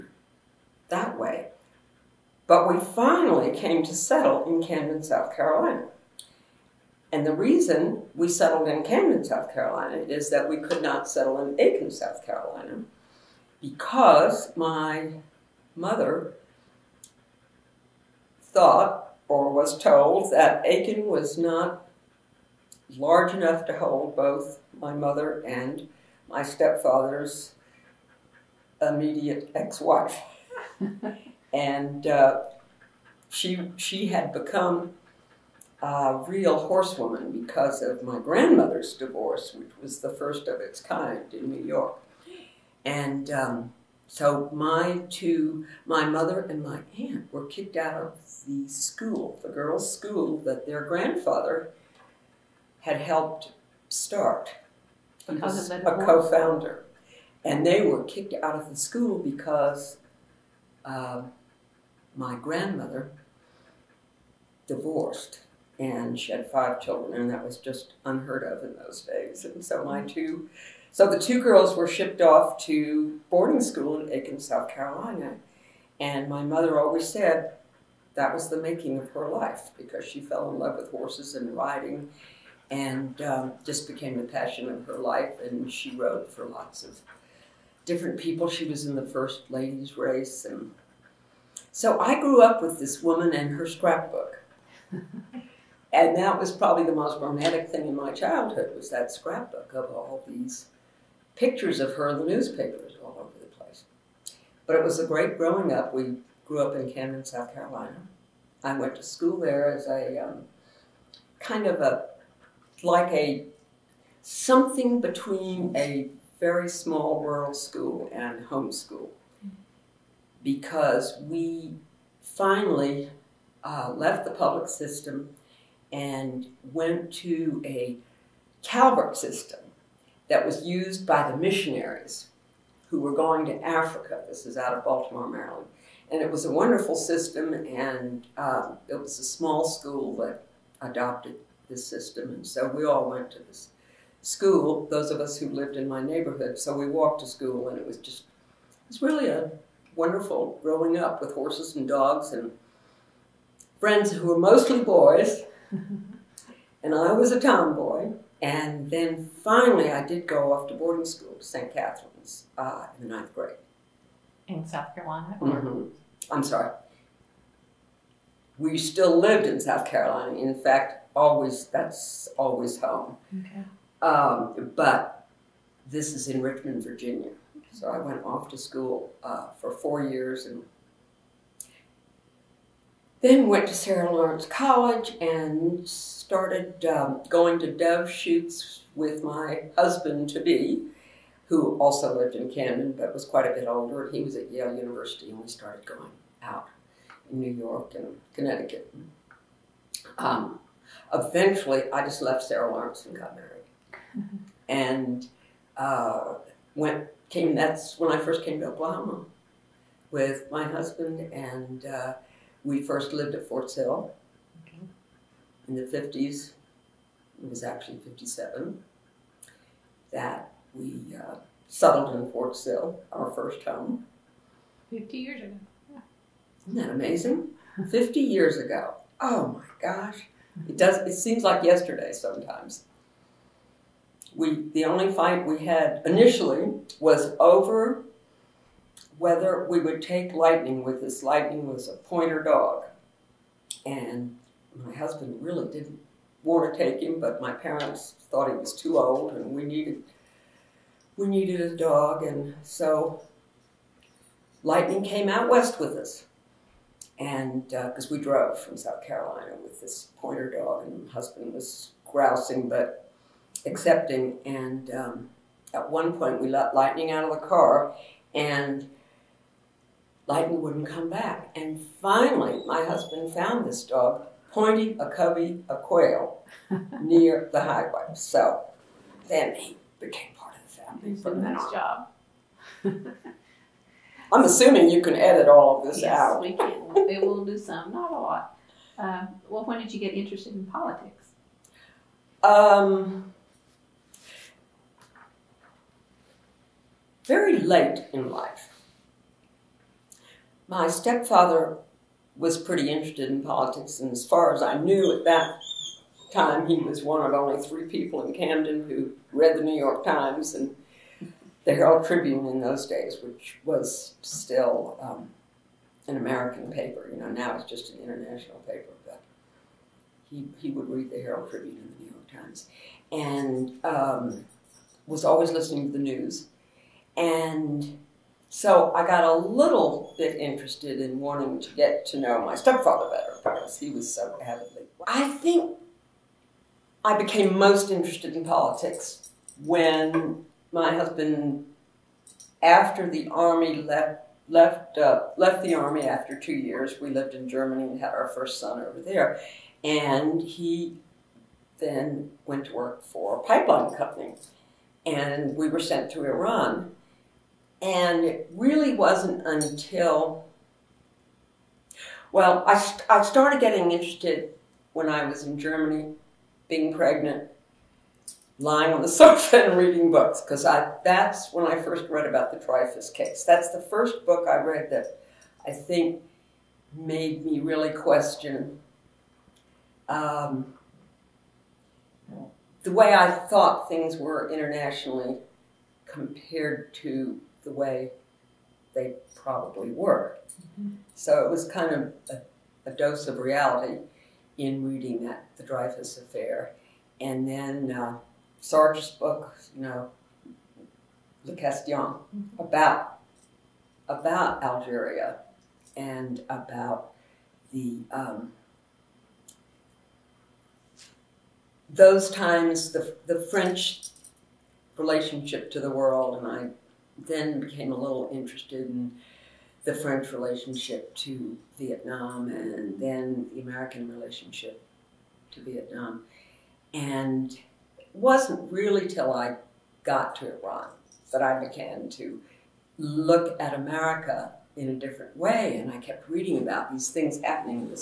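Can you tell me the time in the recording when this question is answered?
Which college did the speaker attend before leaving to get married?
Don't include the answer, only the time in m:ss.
3:03.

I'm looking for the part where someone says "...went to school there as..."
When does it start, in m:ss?
1:48.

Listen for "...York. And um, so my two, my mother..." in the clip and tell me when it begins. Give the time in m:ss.
0:41.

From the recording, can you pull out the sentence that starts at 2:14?
This is out of Baltimore, Maryland.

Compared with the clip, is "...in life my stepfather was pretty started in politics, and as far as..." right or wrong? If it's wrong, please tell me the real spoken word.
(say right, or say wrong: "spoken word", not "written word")
wrong: "interested", not "started".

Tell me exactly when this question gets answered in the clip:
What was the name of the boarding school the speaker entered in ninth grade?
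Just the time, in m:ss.
2:41.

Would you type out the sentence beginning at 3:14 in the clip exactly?
He was at Yale University and we started going out in New York and Connecticut.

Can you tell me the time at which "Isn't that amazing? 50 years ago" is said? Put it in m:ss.
3:46.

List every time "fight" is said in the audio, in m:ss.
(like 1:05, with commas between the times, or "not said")
3:55.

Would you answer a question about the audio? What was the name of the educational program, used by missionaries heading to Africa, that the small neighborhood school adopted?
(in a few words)
Calvert system.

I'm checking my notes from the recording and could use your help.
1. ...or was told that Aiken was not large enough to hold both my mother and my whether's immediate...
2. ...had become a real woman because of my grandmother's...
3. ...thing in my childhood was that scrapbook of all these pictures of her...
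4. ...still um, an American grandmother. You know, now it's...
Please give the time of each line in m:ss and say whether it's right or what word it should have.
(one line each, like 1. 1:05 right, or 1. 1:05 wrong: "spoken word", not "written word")
1. 0:19 wrong: "stepfather", not "whether"
2. 0:34 wrong: "horsewoman", not "woman"
3. 1:37 right
4. 5:14 wrong: "paper", not "grandmother".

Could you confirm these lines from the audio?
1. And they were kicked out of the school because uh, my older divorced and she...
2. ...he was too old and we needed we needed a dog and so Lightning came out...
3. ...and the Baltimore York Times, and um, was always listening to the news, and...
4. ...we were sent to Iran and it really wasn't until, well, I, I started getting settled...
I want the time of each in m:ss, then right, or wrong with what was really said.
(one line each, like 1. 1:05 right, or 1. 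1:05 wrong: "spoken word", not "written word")
1. 0:57 wrong: "grandmother", not "older"
2. 4:08 right
3. 5:21 wrong: "New", not "Baltimore"
4. 5:55 wrong: "interested", not "settled".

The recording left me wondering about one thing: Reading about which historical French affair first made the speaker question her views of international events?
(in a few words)
Dreyfus case.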